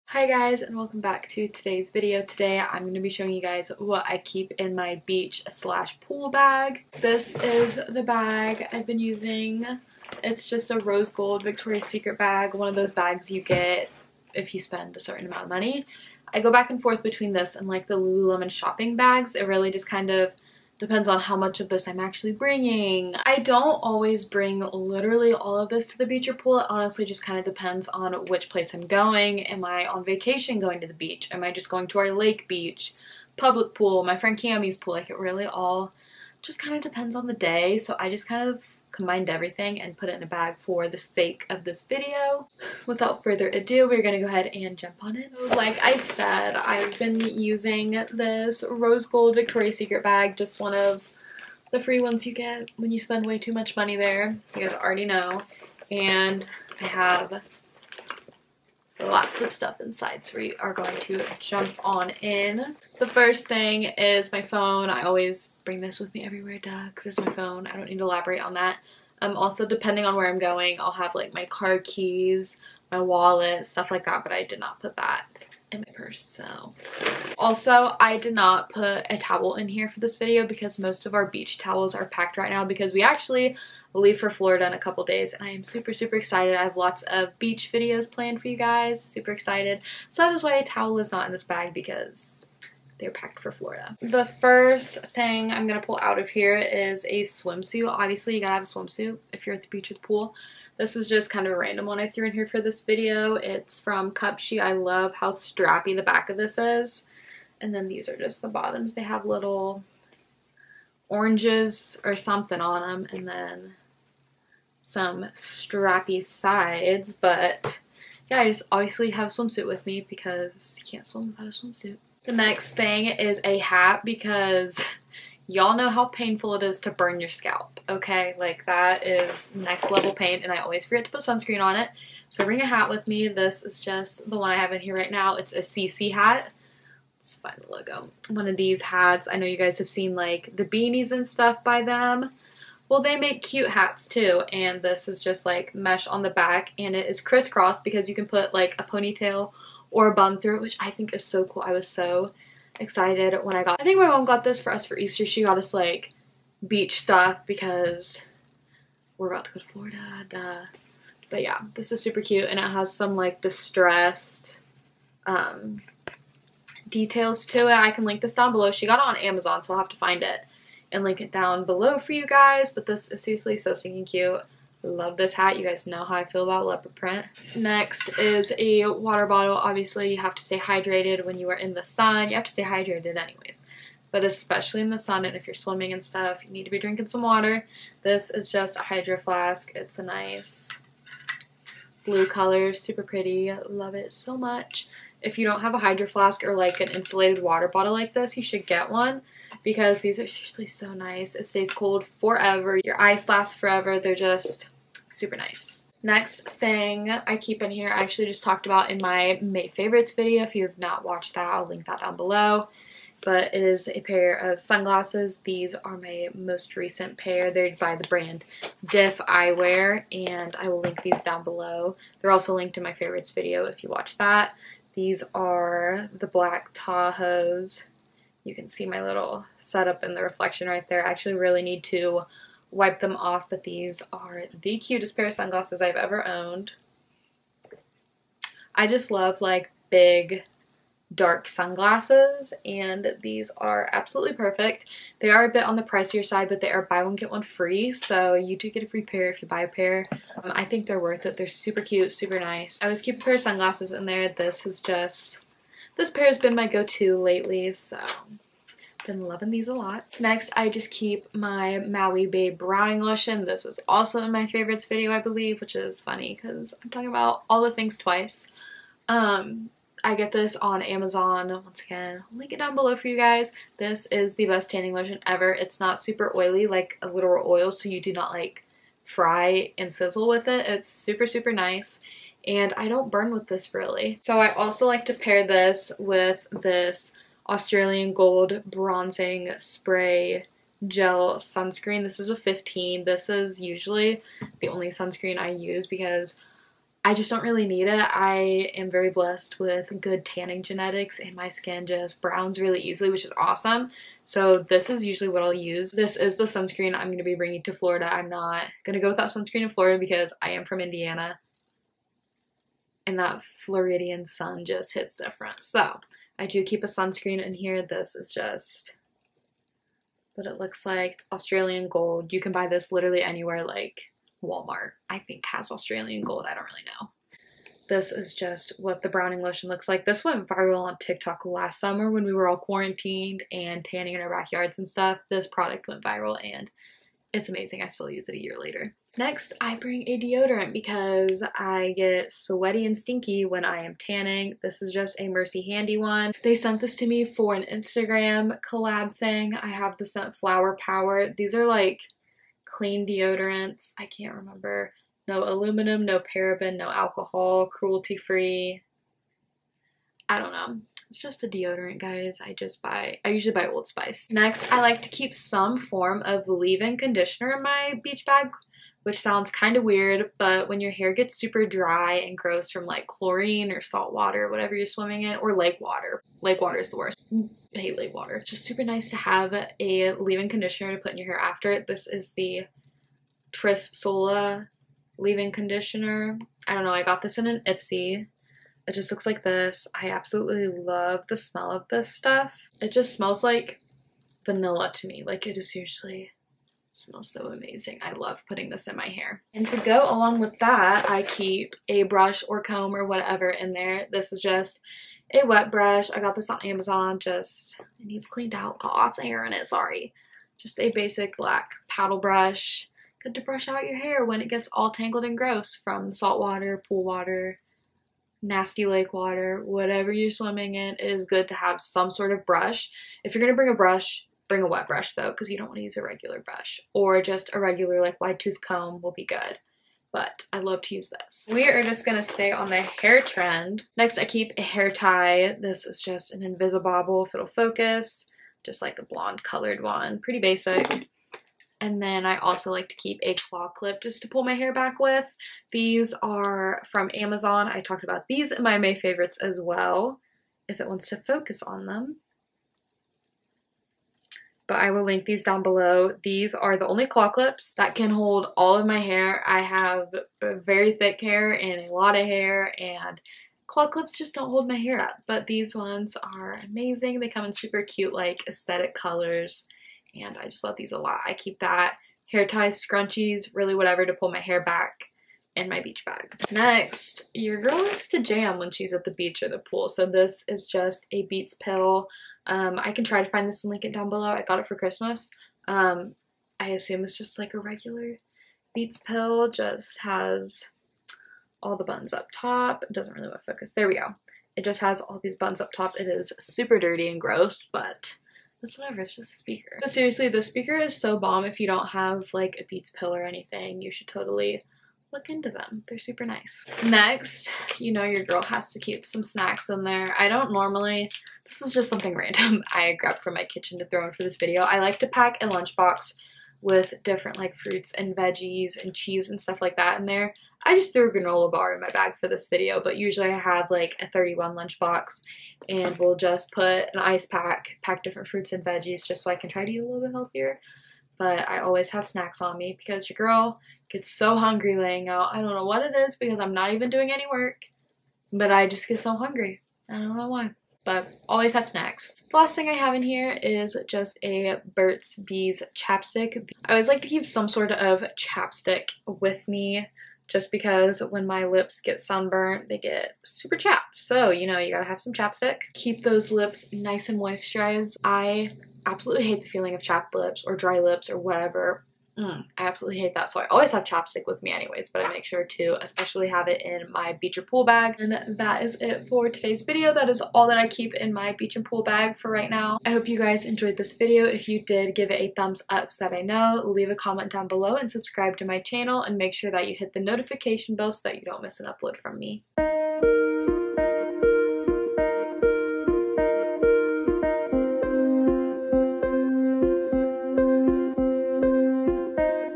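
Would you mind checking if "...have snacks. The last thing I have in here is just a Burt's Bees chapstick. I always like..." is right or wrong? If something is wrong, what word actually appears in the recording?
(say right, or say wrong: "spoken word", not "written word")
right.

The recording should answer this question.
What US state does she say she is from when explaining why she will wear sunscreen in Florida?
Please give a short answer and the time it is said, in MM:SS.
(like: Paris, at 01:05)
Indiana, at 05:10.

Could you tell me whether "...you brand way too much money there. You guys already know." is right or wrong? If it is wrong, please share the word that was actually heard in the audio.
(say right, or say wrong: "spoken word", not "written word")
wrong: "spend", not "brand".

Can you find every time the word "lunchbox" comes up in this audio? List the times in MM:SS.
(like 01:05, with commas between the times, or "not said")
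08:35, 08:44.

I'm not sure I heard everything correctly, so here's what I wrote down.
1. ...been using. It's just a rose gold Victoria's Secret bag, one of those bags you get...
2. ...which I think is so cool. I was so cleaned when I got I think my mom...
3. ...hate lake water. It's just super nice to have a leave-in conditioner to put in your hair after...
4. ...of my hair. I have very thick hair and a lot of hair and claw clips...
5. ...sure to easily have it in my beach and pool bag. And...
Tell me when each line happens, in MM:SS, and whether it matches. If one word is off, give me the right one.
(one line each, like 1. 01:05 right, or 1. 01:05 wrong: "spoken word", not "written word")
1. 00:08 right
2. 02:30 wrong: "excited", not "cleaned"
3. 06:17 right
4. 07:38 right
5. 09:25 wrong: "especially", not "easily".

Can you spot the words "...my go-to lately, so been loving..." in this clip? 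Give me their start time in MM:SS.
04:16.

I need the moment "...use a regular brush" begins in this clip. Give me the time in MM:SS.
07:05.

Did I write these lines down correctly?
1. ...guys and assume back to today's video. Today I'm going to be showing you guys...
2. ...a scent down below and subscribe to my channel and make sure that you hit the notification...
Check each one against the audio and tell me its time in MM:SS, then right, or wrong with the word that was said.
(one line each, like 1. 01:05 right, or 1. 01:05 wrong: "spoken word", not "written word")
1. 00:00 wrong: "welcome", not "assume"
2. 09:36 wrong: "comment", not "scent".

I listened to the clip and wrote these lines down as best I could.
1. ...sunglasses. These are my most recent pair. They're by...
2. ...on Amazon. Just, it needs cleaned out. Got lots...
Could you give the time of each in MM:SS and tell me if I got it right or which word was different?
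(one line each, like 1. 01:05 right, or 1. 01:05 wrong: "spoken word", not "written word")
1. 03:34 right
2. 06:46 right.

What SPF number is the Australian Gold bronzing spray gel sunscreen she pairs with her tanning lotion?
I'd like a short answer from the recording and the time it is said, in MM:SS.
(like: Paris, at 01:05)
15, at 04:52.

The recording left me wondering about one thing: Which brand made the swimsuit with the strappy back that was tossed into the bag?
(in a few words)
Cupshe.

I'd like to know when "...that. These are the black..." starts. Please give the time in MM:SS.
03:44.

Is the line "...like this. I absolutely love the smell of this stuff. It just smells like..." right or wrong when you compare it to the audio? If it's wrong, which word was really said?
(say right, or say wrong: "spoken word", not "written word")
right.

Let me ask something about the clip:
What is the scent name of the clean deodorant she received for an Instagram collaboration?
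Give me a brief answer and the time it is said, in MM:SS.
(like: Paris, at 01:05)
Flower Power, at 05:50.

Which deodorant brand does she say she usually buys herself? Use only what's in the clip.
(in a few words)
Old Spice.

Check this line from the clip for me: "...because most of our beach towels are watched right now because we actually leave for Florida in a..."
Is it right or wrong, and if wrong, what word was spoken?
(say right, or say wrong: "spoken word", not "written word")
wrong: "packed", not "watched".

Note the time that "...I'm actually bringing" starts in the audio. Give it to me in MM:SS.
00:21.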